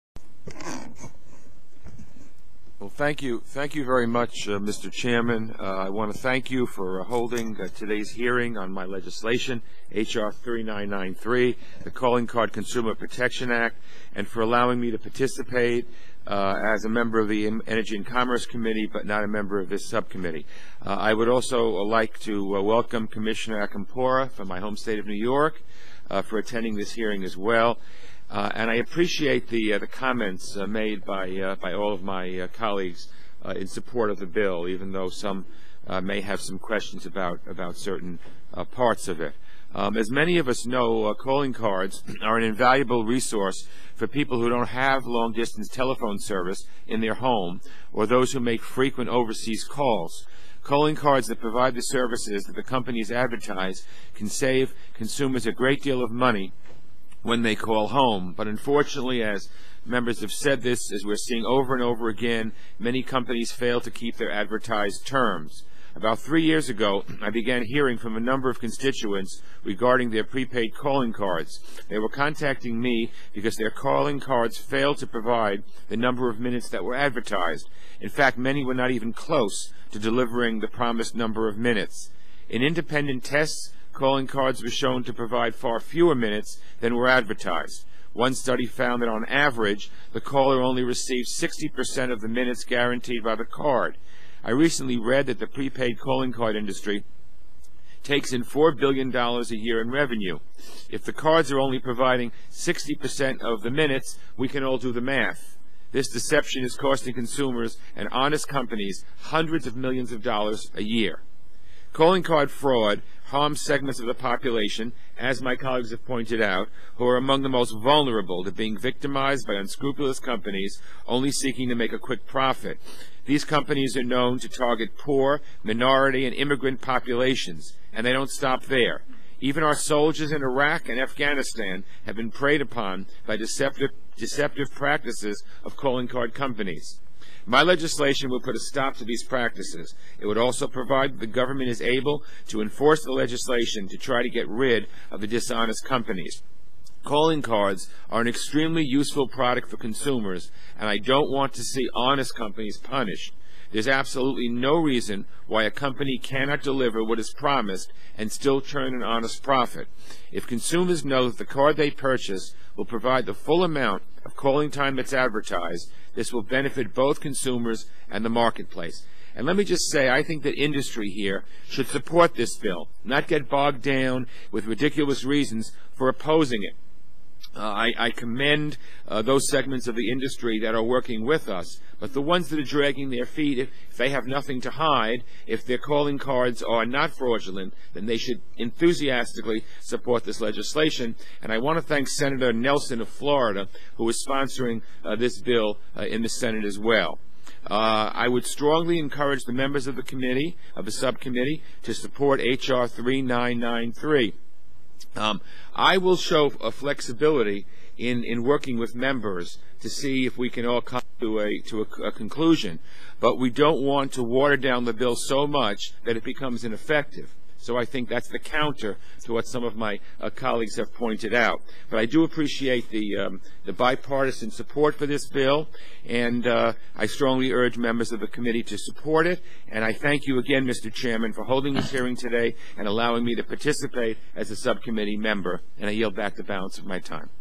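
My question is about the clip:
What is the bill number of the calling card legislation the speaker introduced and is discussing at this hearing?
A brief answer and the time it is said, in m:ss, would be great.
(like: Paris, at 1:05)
H.R. 3993, at 0:09.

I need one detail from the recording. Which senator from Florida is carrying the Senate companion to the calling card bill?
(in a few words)
Senator Nelson.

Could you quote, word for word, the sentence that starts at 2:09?
Even our soldiers in Iraq and Afghanistan have been preyed upon by deceptive, deceptive practices of calling card companies.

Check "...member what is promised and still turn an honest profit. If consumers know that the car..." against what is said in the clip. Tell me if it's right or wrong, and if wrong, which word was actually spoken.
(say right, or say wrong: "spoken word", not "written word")
wrong: "deliver", not "member".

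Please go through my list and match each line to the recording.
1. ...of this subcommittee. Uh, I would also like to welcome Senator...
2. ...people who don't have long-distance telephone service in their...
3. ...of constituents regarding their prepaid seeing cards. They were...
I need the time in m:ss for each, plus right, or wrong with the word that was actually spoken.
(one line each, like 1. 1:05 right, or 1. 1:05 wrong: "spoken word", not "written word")
1. 0:19 wrong: "Commissioner", not "Senator"
2. 0:44 right
3. 1:08 wrong: "calling", not "seeing".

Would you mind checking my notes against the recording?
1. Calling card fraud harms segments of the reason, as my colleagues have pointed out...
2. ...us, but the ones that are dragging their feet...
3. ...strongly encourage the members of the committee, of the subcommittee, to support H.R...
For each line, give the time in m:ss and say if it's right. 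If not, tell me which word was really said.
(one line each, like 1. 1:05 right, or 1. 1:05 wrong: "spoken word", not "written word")
1. 1:51 wrong: "population", not "reason"
2. 3:01 right
3. 3:18 right.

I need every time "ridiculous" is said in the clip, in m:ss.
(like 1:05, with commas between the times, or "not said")
2:54.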